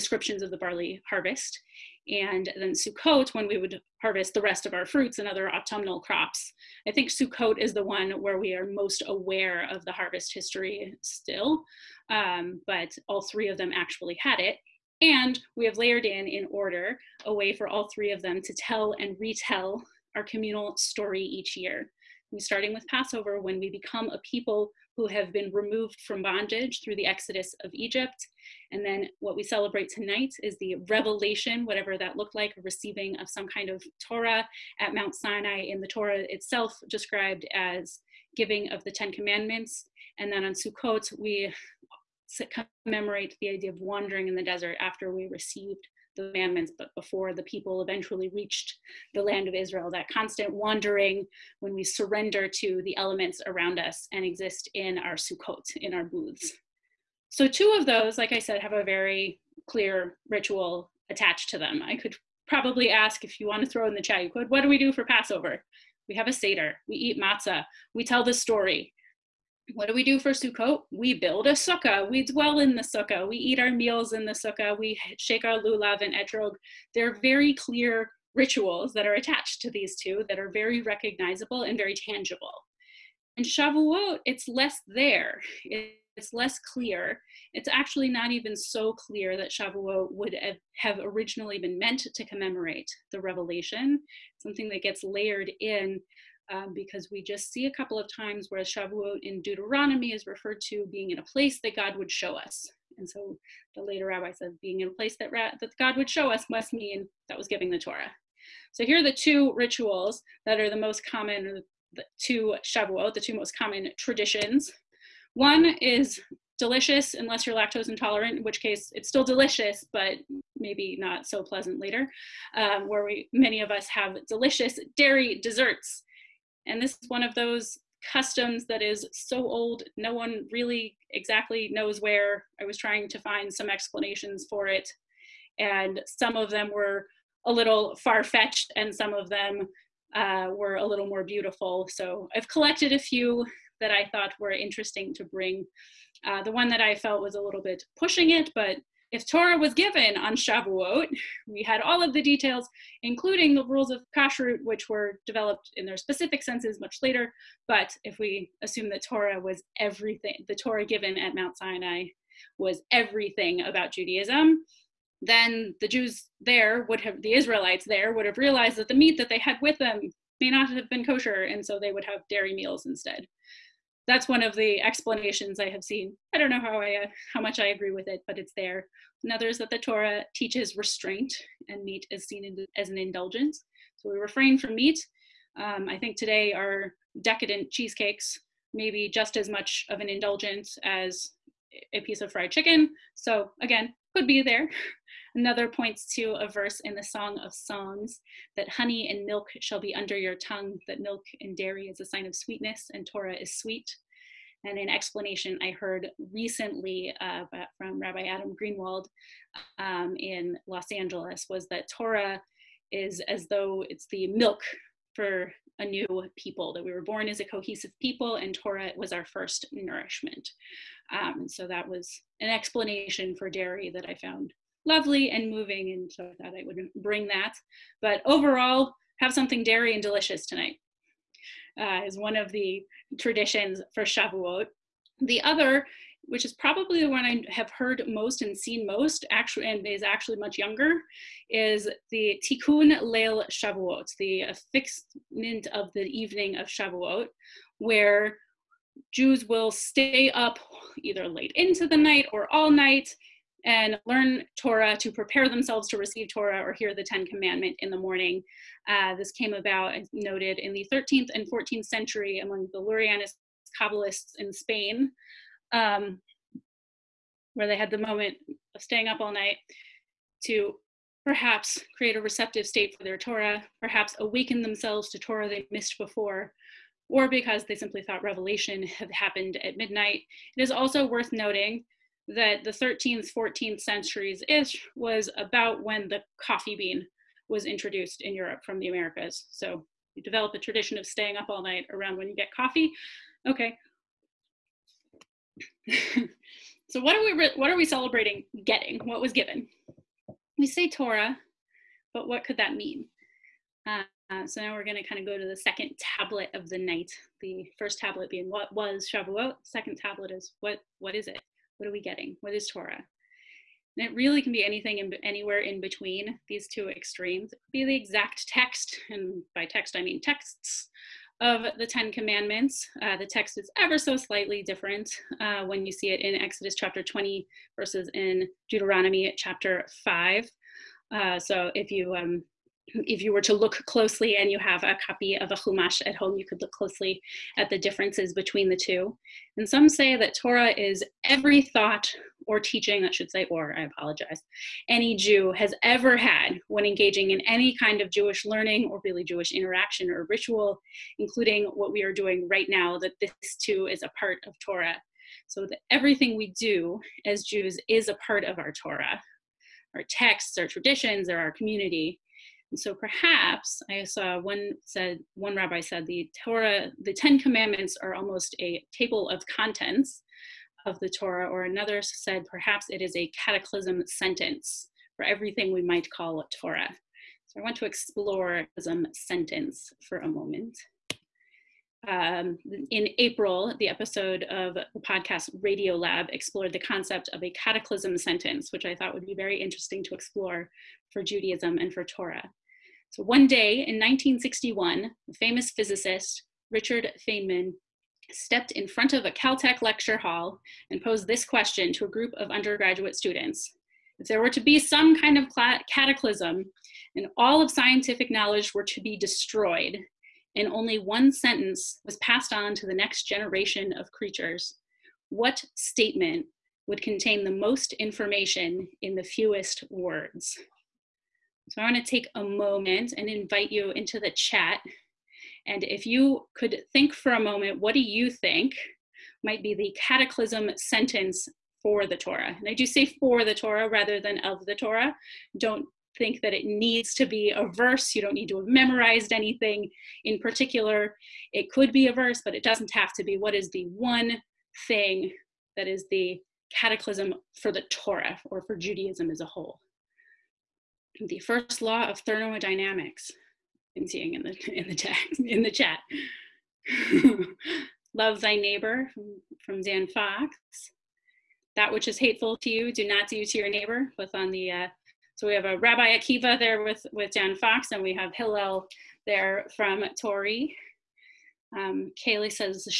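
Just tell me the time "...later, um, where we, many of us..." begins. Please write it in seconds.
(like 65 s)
121 s.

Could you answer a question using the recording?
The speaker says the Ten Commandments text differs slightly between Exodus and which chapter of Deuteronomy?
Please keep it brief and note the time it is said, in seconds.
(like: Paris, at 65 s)
Chapter 5, at 328 s.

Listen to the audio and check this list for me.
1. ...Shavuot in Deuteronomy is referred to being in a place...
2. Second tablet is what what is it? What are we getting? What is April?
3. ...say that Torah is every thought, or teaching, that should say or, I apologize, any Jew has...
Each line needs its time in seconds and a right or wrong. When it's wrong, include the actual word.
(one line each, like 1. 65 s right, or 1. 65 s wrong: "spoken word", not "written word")
1. 98 s right
2. 309 s wrong: "Torah", not "April"
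3. 339 s right.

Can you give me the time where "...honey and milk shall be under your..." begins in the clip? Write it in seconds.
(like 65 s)
198 s.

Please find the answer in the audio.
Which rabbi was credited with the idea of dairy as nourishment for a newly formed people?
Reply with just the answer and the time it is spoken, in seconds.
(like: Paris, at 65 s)
Adam Greenwald, at 207 s.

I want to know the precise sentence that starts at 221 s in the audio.
Um, so that was an explanation for dairy that I found lovely and moving, and so I thought I would bring that.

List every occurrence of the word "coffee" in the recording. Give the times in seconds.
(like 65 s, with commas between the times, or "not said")
286 s, 292 s.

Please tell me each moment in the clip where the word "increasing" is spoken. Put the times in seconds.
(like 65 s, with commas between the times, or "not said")
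not said.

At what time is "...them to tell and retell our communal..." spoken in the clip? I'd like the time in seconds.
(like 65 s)
18 s.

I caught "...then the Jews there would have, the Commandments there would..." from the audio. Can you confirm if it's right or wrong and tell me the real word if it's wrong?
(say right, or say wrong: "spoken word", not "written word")
wrong: "Israelites", not "Commandments".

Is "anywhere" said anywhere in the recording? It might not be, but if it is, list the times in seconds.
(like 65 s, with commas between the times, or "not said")
315 s.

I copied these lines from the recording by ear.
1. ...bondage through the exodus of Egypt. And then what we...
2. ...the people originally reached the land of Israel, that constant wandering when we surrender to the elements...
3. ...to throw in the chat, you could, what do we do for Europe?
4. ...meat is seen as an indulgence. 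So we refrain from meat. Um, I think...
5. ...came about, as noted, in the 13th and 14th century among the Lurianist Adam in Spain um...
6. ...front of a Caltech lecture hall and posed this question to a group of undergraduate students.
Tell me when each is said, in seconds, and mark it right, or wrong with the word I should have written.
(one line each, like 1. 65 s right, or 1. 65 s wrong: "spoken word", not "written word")
1. 26 s right
2. 47 s wrong: "eventually", not "originally"
3. 63 s wrong: "Passover", not "Europe"
4. 181 s right
5. 259 s wrong: "Kabbalists", not "Adam"
6. 398 s right.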